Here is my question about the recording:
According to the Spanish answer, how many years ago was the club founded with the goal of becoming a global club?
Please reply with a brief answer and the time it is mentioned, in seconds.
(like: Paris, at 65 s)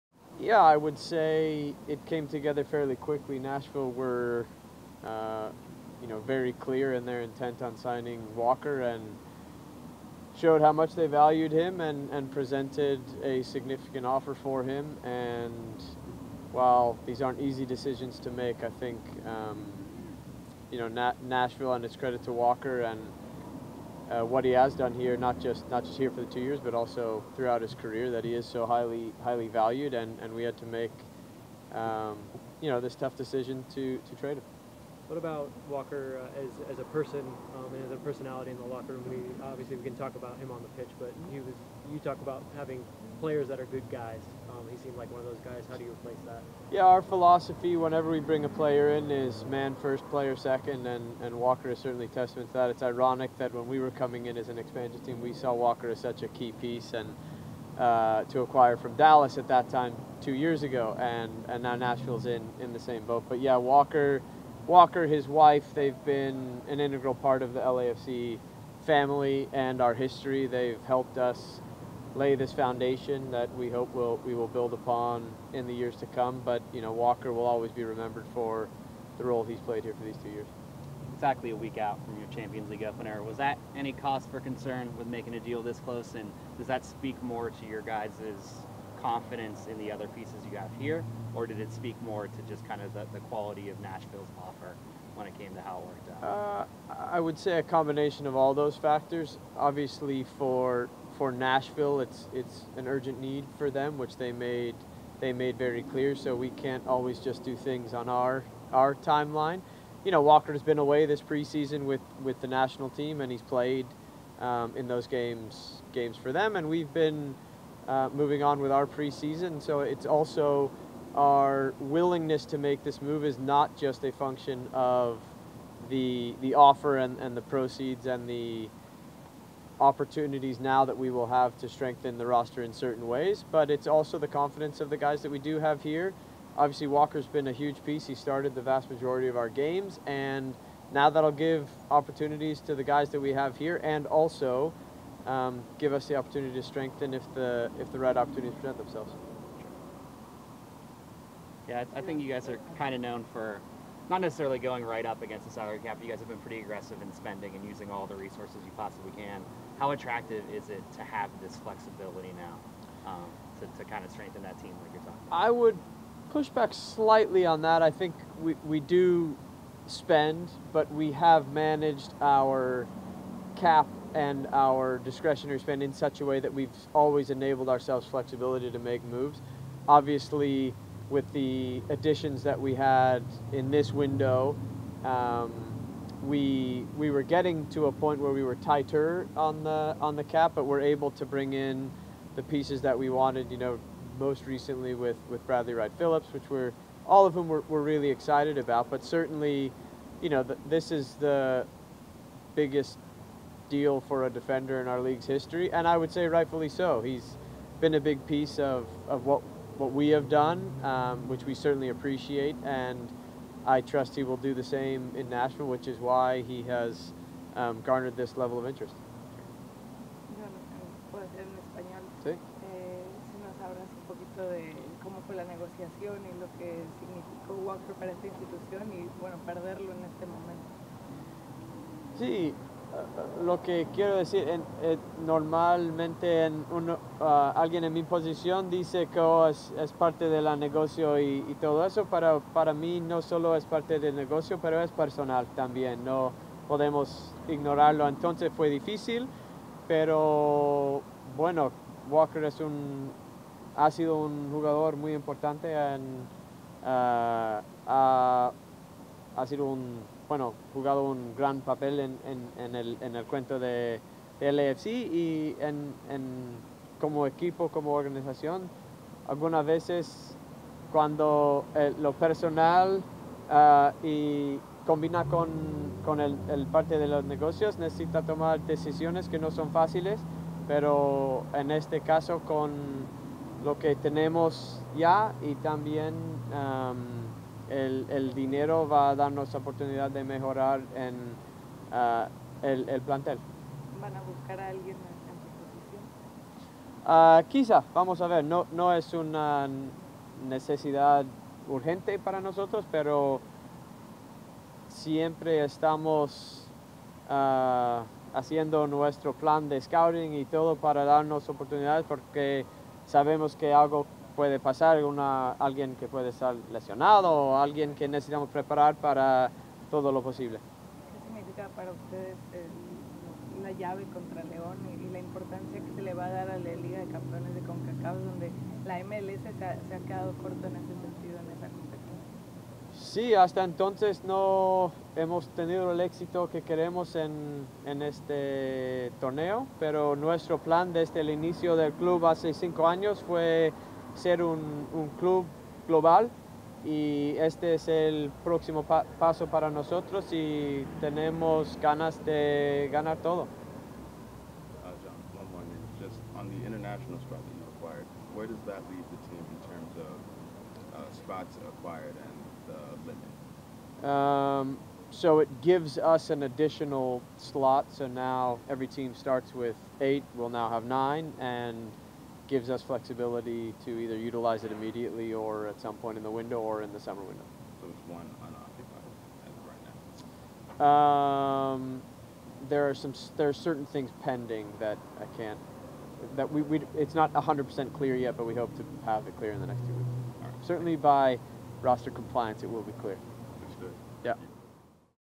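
5, at 342 s.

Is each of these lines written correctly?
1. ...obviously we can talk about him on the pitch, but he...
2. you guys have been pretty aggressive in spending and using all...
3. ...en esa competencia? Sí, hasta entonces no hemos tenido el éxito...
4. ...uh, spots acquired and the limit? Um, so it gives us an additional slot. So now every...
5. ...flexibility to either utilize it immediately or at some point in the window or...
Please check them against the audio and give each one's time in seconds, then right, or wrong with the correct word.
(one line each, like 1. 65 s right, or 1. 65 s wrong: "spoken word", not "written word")
1. 39 s right
2. 156 s right
3. 331 s right
4. 360 s right
5. 372 s right.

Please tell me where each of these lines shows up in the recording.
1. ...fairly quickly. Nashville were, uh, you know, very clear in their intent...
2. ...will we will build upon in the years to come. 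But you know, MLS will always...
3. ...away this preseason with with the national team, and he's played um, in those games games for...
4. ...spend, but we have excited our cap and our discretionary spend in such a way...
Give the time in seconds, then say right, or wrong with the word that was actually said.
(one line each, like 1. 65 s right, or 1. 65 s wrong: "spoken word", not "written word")
1. 2 s right
2. 73 s wrong: "Walker", not "MLS"
3. 110 s right
4. 169 s wrong: "managed", not "excited".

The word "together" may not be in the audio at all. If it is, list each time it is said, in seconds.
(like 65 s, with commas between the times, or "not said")
2 s.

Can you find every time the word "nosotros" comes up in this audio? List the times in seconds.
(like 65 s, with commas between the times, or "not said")
302 s, 349 s.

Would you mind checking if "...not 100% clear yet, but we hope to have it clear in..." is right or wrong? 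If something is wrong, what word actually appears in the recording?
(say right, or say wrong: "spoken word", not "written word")
right.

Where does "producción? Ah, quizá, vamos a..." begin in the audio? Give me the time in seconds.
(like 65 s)
296 s.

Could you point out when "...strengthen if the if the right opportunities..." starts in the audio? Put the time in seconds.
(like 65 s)
146 s.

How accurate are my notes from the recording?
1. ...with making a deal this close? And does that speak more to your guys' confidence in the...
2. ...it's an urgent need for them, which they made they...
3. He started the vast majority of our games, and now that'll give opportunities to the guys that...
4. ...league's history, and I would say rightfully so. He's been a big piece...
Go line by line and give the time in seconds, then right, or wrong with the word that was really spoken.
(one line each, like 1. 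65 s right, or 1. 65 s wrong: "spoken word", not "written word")
1. 84 s right
2. 102 s right
3. 138 s right
4. 205 s right.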